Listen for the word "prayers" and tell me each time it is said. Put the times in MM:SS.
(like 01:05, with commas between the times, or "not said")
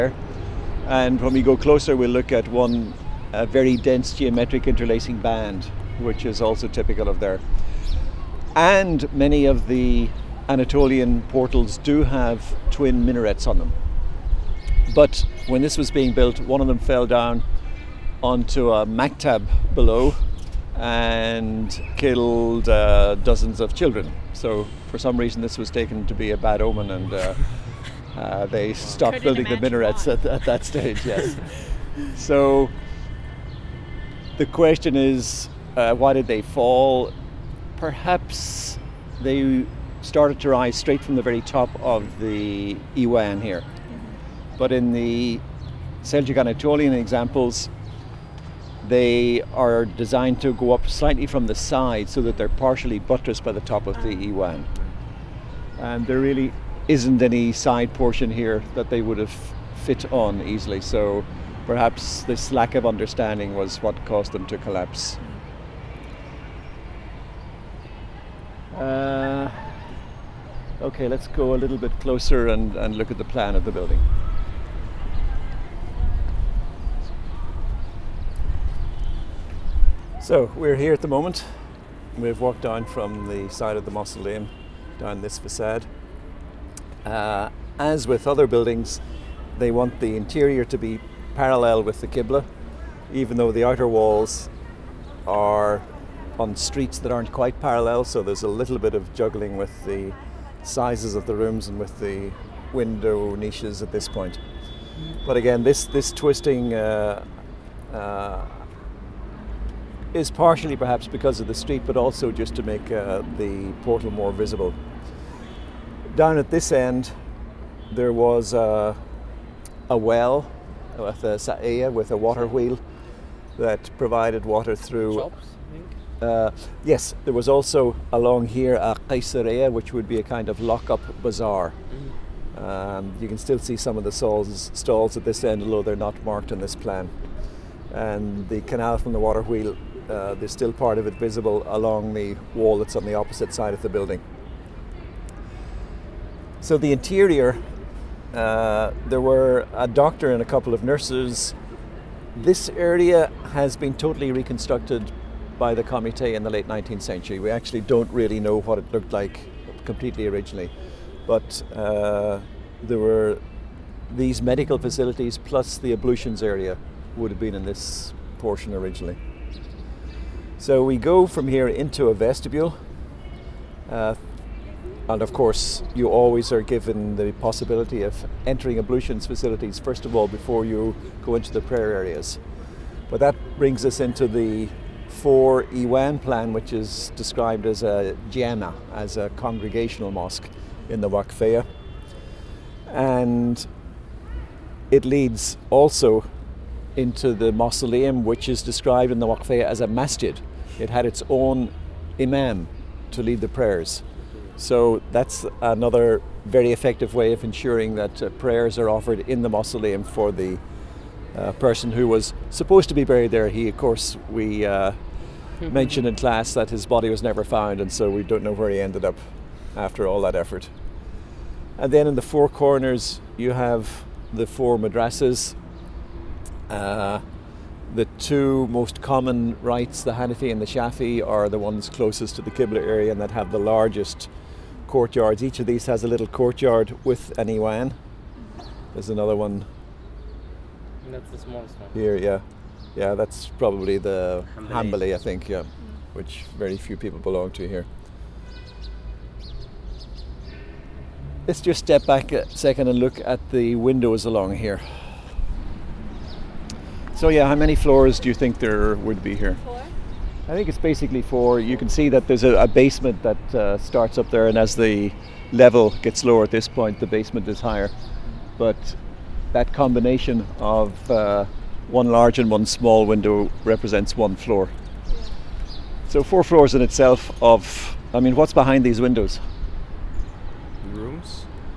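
03:01, 03:23, 03:28.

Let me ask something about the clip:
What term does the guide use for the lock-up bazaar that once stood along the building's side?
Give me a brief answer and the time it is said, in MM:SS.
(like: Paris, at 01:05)
Caesarea, at 02:09.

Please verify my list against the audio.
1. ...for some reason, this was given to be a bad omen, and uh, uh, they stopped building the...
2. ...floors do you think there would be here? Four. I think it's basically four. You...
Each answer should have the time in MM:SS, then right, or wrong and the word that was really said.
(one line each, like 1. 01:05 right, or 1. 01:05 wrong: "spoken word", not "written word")
1. 00:24 wrong: "taken", not "given"
2. 04:17 right.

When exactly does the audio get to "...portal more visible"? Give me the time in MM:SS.
01:53.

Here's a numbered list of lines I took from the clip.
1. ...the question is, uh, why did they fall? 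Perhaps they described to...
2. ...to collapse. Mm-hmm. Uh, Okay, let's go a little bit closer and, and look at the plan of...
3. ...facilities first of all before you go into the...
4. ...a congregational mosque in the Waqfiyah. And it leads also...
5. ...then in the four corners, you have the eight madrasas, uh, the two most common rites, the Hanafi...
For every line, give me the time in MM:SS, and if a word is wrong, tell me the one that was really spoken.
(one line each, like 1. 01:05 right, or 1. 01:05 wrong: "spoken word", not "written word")
1. 00:34 wrong: "started", not "described"
2. 01:04 right
3. 02:59 right
4. 03:09 right
5. 03:41 wrong: "four", not "eight".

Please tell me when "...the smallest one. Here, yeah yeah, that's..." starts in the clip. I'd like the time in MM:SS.
04:01.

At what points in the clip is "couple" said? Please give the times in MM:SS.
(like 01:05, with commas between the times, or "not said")
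02:30.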